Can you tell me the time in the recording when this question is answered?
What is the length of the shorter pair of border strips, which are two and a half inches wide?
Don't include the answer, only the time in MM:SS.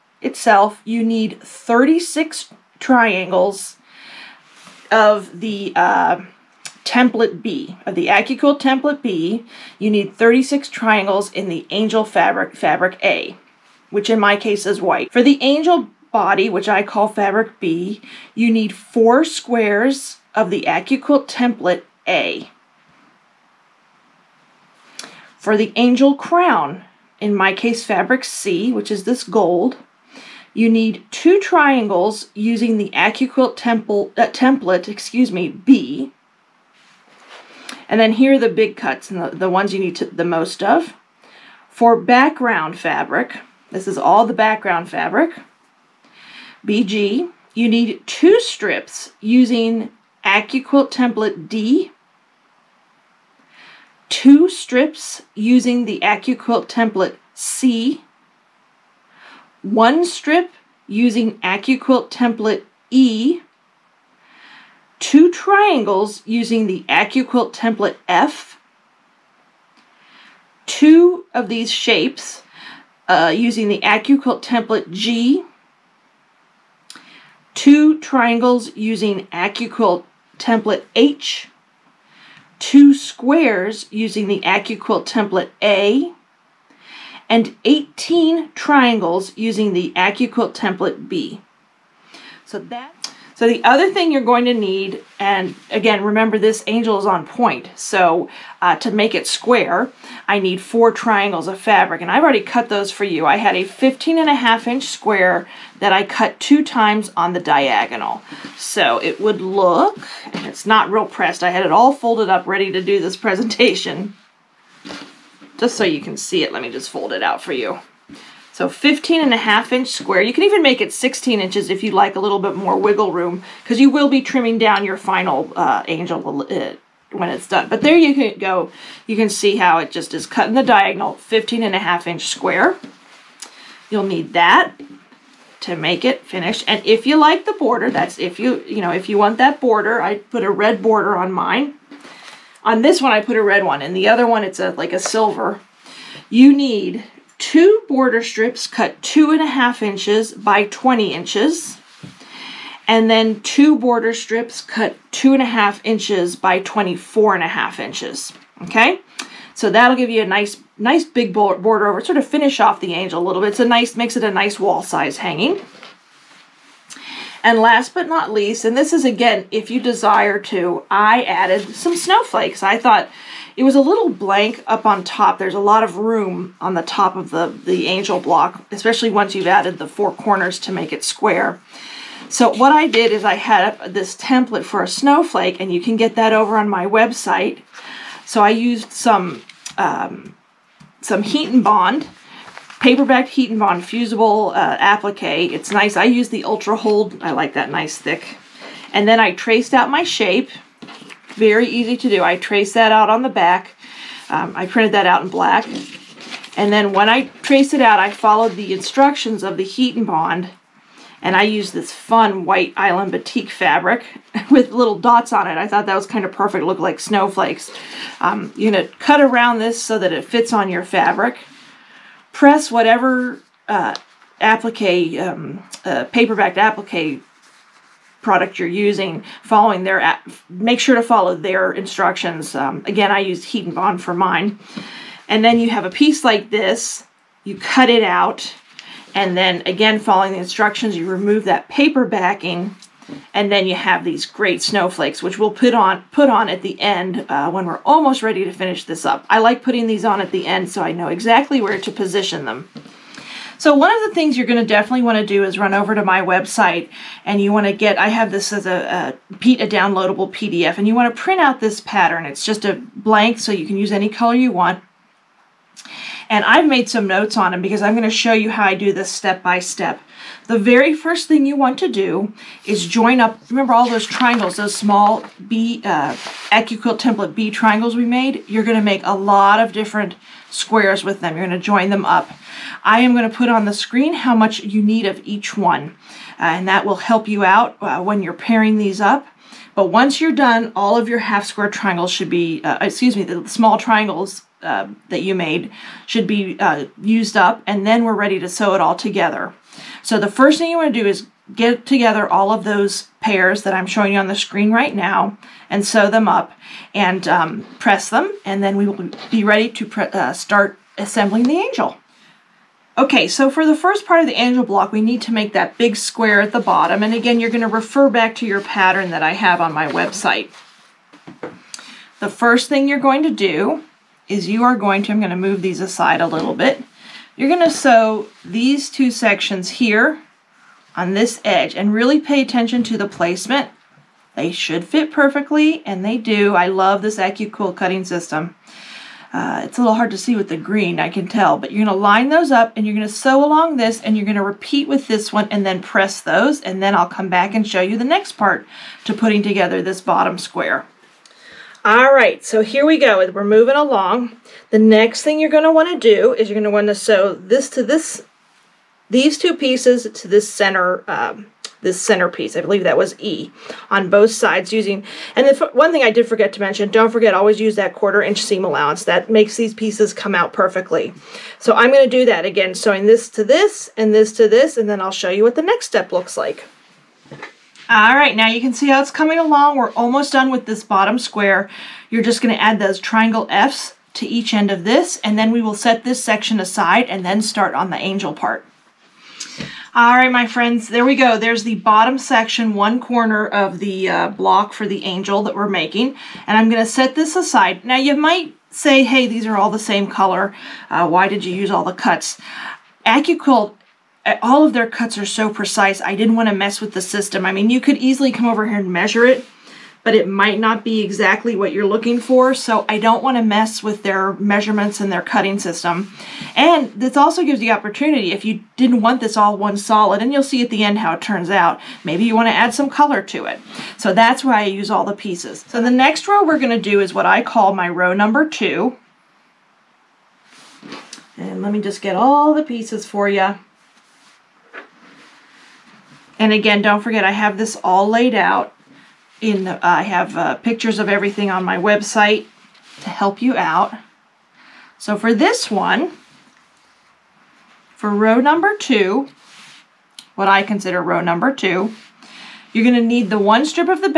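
02:30.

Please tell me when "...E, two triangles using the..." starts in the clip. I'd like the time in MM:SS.
01:02.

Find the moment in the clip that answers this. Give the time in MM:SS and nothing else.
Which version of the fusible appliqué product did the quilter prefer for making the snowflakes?
03:16.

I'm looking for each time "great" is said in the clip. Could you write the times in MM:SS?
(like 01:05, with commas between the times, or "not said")
04:04.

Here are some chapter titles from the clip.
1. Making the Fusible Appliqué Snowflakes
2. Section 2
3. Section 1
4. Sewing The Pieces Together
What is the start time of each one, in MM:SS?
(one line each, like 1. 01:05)
1. 02:50
2. 07:07
3. 05:13
4. 04:34.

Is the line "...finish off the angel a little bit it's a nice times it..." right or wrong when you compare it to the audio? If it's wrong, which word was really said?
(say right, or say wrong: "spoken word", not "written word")
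wrong: "makes", not "times".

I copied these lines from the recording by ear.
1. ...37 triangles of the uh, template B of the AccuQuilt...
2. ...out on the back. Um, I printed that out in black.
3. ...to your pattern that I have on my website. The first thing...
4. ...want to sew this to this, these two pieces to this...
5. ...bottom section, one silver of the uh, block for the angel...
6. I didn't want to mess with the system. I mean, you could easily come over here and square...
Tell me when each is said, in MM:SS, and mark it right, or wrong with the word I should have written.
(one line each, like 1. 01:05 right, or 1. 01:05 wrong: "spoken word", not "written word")
1. 00:01 wrong: "36", not "37"
2. 03:22 right
3. 05:18 right
4. 05:56 right
5. 06:31 wrong: "corner", not "silver"
6. 06:46 wrong: "measure", not "square".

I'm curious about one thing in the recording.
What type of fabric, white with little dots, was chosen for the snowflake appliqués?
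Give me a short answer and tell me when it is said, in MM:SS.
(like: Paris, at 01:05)
batik, at 03:33.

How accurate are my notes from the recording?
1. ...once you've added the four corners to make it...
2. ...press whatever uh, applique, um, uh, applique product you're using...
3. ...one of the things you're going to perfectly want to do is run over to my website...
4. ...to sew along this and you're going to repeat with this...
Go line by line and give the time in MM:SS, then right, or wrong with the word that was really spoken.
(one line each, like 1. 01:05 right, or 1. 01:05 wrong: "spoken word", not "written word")
1. 02:59 right
2. 03:42 right
3. 04:13 wrong: "definitely", not "perfectly"
4. 05:43 right.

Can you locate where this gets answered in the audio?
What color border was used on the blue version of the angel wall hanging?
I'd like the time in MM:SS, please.
02:25.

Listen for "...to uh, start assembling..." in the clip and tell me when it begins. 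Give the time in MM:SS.
05:09.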